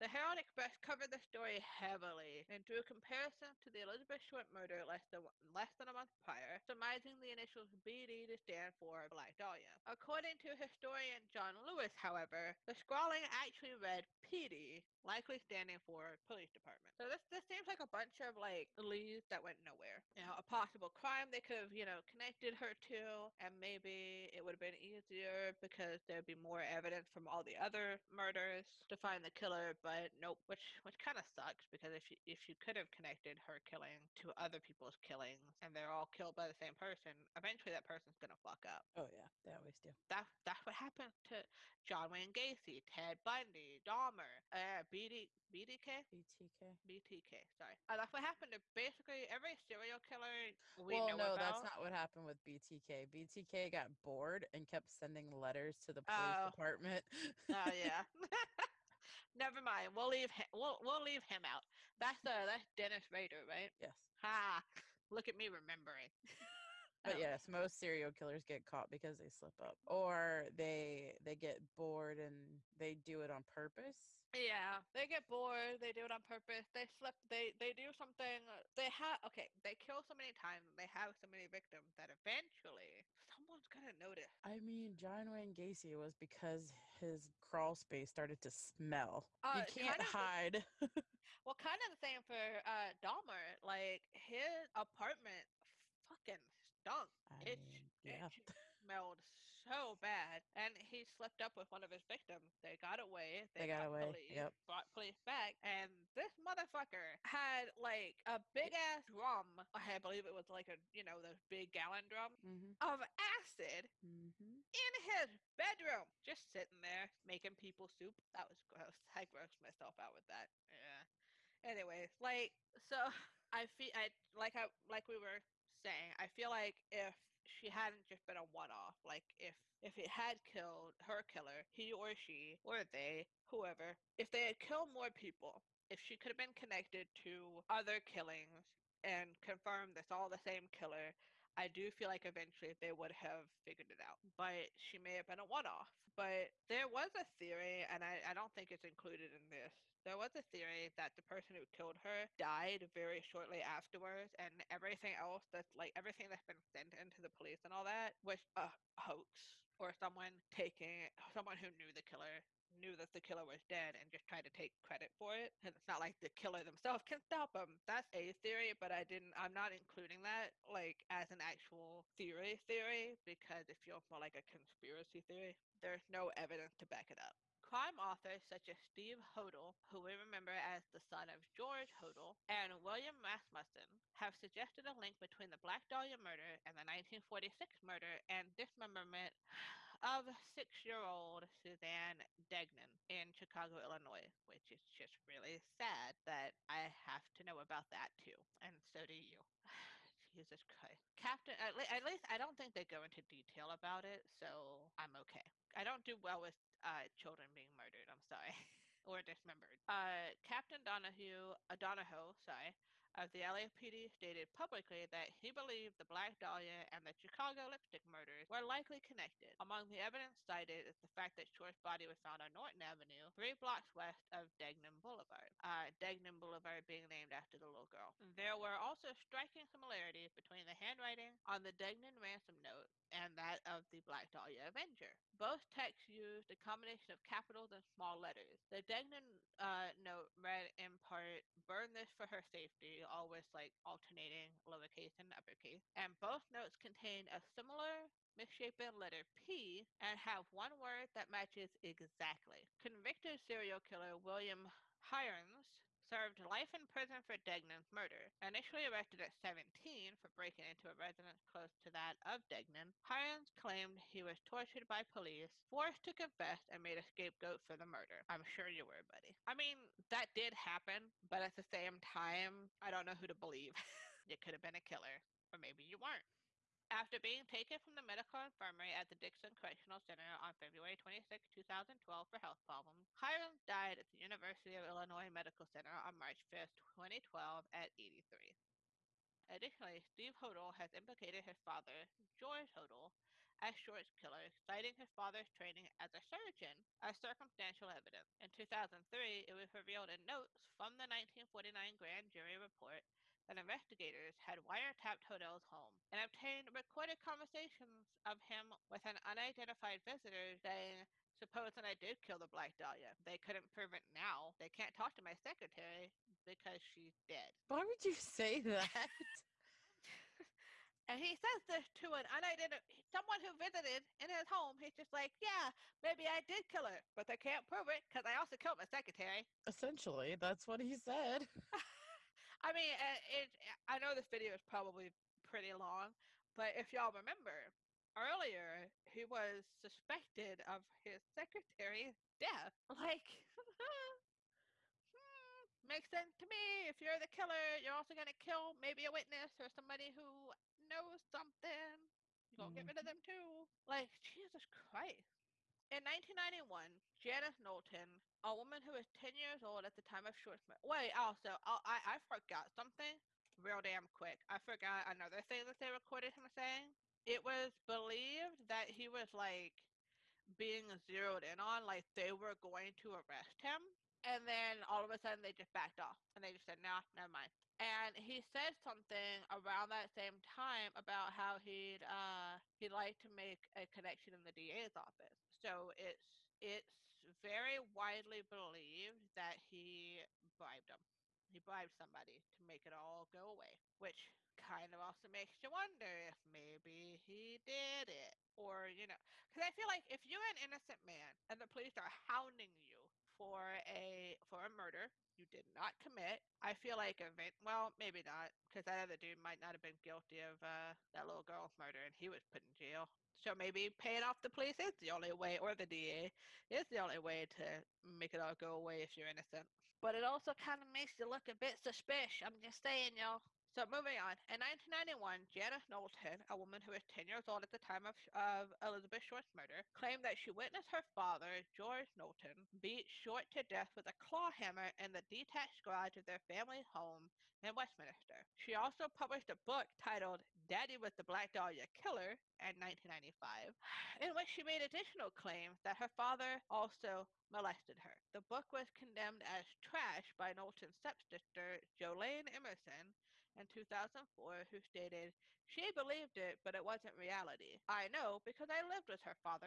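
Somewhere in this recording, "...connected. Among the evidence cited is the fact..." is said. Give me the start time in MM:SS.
03:38.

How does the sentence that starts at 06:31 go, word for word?
He bribed somebody to make it all go away, which kind of also makes you wonder if maybe he did it.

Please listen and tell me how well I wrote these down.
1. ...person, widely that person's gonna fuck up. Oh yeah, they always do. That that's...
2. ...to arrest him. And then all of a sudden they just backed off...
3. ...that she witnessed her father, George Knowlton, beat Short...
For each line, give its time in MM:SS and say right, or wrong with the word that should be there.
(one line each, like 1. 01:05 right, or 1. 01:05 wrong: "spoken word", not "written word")
1. 00:36 wrong: "eventually", not "widely"
2. 06:12 right
3. 07:10 right.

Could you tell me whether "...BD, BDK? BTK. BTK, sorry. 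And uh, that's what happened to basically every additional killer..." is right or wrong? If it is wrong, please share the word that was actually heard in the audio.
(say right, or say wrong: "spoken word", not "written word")
wrong: "serial", not "additional".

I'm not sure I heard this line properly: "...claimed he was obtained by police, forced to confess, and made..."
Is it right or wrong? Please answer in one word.
wrong.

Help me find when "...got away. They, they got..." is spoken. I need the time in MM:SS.
01:42.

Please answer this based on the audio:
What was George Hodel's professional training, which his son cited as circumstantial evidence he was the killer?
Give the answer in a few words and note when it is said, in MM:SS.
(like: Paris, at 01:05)
surgeon, at 04:56.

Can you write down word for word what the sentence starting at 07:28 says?
The book was condemned as trash by Knowlton's stepsister, Jolene Emerson, in 2004, who stated, She believed it, but it wasn't reality.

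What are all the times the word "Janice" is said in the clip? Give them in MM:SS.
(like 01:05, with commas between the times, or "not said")
05:57, 07:05.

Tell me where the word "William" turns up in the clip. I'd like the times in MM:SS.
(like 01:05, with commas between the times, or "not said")
03:02, 04:14.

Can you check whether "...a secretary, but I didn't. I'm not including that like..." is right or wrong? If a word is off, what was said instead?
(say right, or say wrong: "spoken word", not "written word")
wrong: "theory", not "secretary".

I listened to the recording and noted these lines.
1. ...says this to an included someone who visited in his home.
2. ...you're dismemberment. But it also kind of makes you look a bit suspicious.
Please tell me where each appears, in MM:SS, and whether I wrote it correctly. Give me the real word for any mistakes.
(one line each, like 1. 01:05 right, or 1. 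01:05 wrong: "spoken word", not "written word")
1. 05:21 wrong: "unidentified", not "included"
2. 06:59 wrong: "innocent", not "dismemberment".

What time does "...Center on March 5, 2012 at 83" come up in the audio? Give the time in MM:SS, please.
04:45.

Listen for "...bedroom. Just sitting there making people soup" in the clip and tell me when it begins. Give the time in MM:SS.
01:55.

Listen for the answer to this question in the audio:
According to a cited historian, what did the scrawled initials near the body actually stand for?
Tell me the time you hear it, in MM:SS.
00:16.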